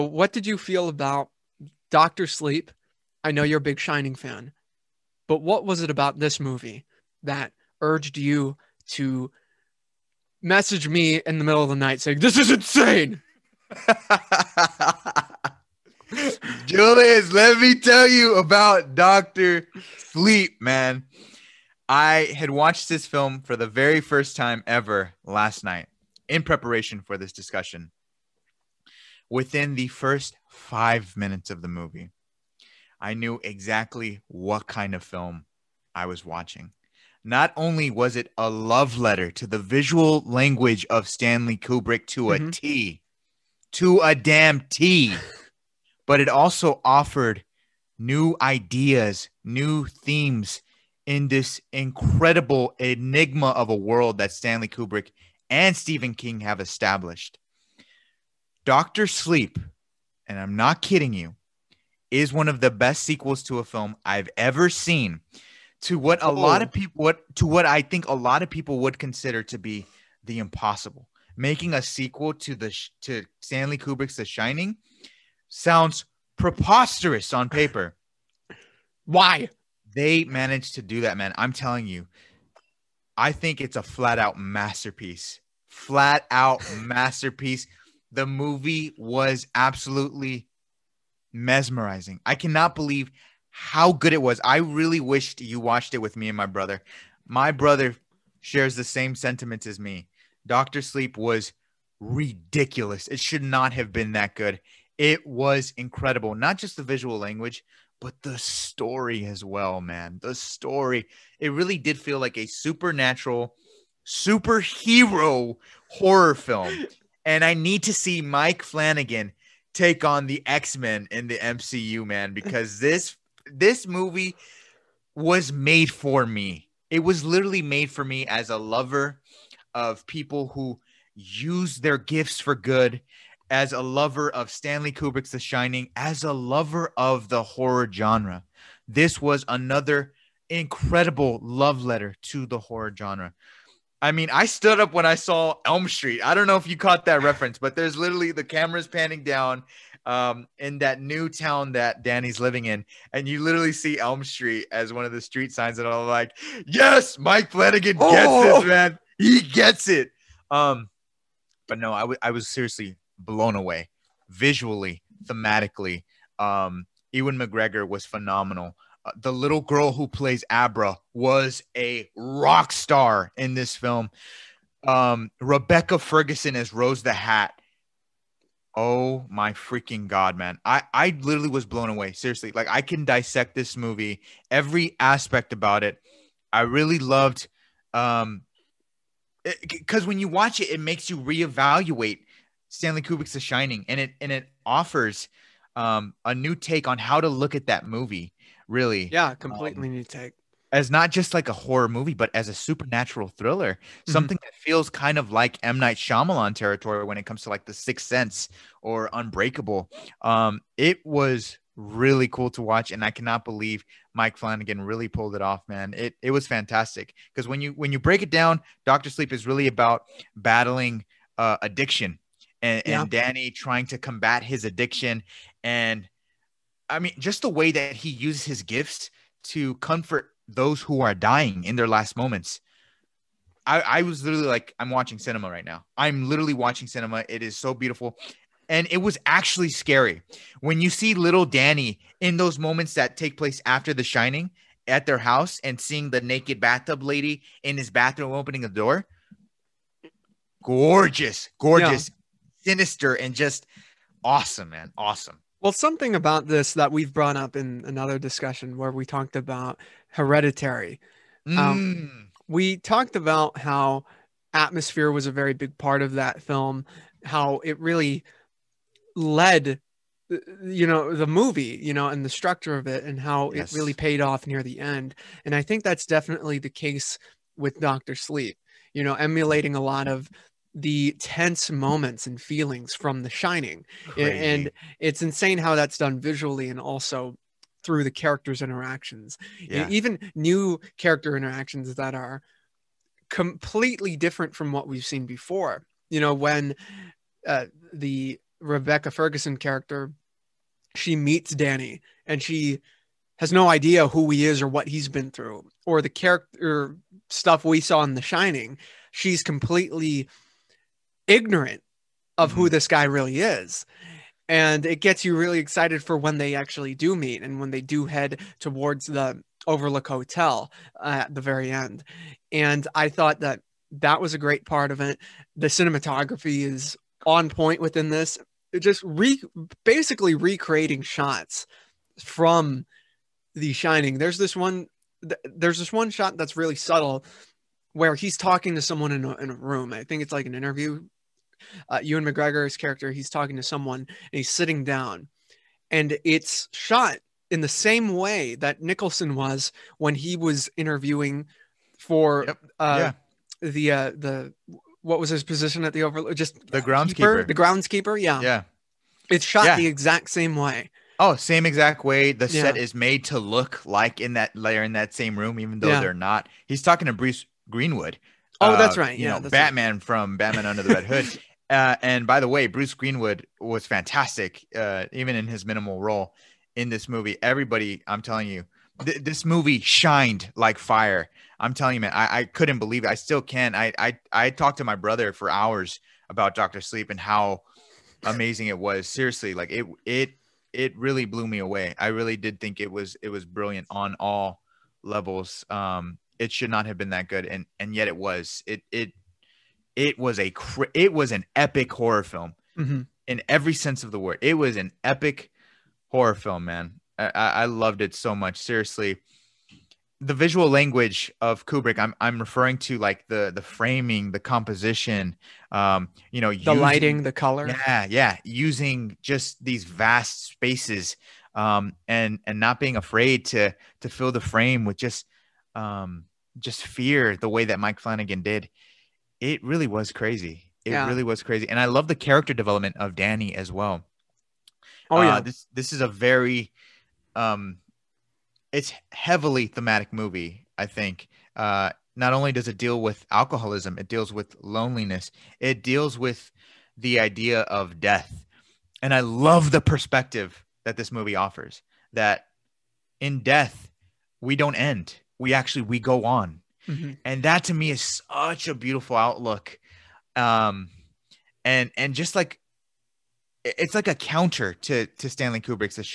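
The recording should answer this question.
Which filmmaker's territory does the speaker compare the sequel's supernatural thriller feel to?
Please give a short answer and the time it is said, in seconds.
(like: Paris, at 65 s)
M. Night Shyamalan, at 205 s.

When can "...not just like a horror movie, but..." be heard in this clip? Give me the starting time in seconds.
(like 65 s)
200 s.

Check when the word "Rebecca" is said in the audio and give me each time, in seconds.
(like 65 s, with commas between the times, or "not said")
175 s, 298 s.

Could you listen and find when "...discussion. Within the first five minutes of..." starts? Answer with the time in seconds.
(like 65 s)
27 s.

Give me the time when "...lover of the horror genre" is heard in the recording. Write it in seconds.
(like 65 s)
136 s.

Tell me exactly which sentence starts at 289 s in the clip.
Even new character interactions that are completely different from what we've seen before.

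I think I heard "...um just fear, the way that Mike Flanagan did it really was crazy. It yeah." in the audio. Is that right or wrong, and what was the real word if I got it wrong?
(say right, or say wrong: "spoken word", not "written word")
right.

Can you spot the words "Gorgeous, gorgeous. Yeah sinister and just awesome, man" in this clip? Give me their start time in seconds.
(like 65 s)
250 s.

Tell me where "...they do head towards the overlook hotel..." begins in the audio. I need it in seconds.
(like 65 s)
317 s.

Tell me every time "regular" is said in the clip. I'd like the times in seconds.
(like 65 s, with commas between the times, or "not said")
not said.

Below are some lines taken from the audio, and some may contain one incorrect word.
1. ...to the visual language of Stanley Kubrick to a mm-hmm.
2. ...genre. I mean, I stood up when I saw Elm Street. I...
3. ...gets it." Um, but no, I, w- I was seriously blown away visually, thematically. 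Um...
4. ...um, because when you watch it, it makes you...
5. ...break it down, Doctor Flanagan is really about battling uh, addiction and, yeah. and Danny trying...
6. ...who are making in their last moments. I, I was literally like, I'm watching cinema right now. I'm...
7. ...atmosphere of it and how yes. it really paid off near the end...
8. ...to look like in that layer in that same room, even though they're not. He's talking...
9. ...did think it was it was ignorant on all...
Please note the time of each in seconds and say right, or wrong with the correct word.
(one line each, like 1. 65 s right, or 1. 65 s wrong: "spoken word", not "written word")
1. 39 s right
2. 142 s right
3. 159 s right
4. 187 s right
5. 217 s wrong: "Sleep", not "Flanagan"
6. 230 s wrong: "dying", not "making"
7. 272 s wrong: "structure", not "atmosphere"
8. 363 s right
9. 392 s wrong: "brilliant", not "ignorant".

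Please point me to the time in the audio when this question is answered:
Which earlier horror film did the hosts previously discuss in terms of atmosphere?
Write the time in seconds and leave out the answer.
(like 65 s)
260 s.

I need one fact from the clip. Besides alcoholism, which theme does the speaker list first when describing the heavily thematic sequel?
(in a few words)
loneliness.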